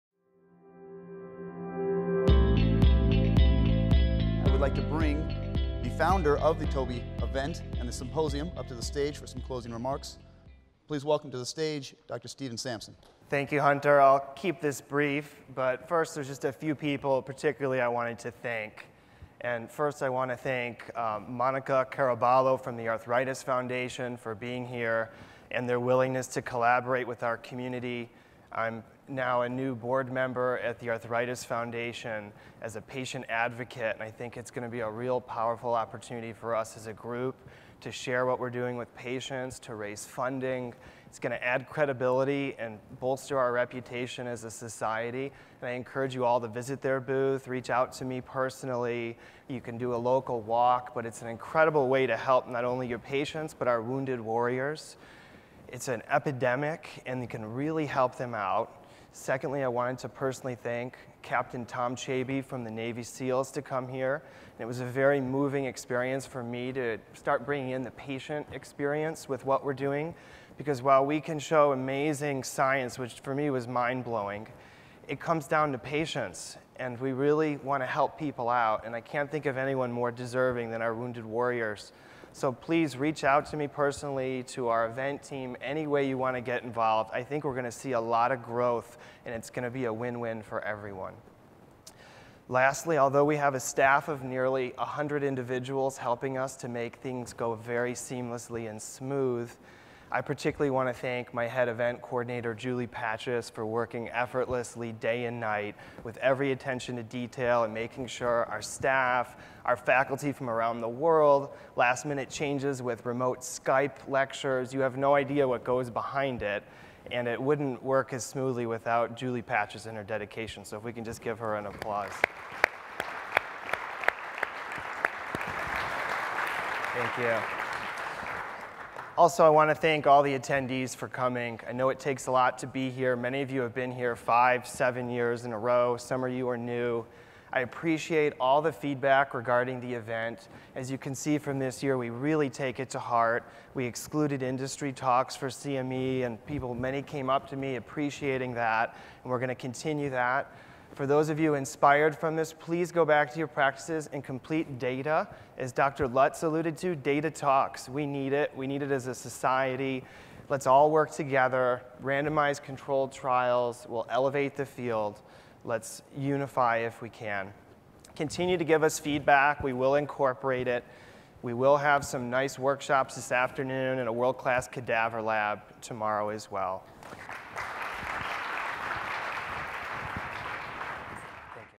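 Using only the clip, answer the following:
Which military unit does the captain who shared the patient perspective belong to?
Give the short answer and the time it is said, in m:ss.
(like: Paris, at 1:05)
Navy SEALs, at 1:02.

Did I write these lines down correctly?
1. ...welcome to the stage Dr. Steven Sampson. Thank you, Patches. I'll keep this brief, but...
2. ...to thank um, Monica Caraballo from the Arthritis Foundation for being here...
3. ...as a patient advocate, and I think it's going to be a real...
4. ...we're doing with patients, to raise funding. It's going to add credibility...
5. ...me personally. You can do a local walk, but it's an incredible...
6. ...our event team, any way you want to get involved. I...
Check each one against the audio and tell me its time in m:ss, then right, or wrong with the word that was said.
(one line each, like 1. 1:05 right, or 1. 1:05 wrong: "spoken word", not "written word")
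1. 0:11 wrong: "Hunter", not "Patches"
2. 0:20 right
3. 0:32 right
4. 0:38 right
5. 0:48 right
6. 1:24 right.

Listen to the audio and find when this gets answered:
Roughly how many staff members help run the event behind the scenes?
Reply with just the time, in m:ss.
1:34.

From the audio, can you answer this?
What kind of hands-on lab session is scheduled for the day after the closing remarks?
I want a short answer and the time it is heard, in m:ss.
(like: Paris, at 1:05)
cadaver lab, at 2:54.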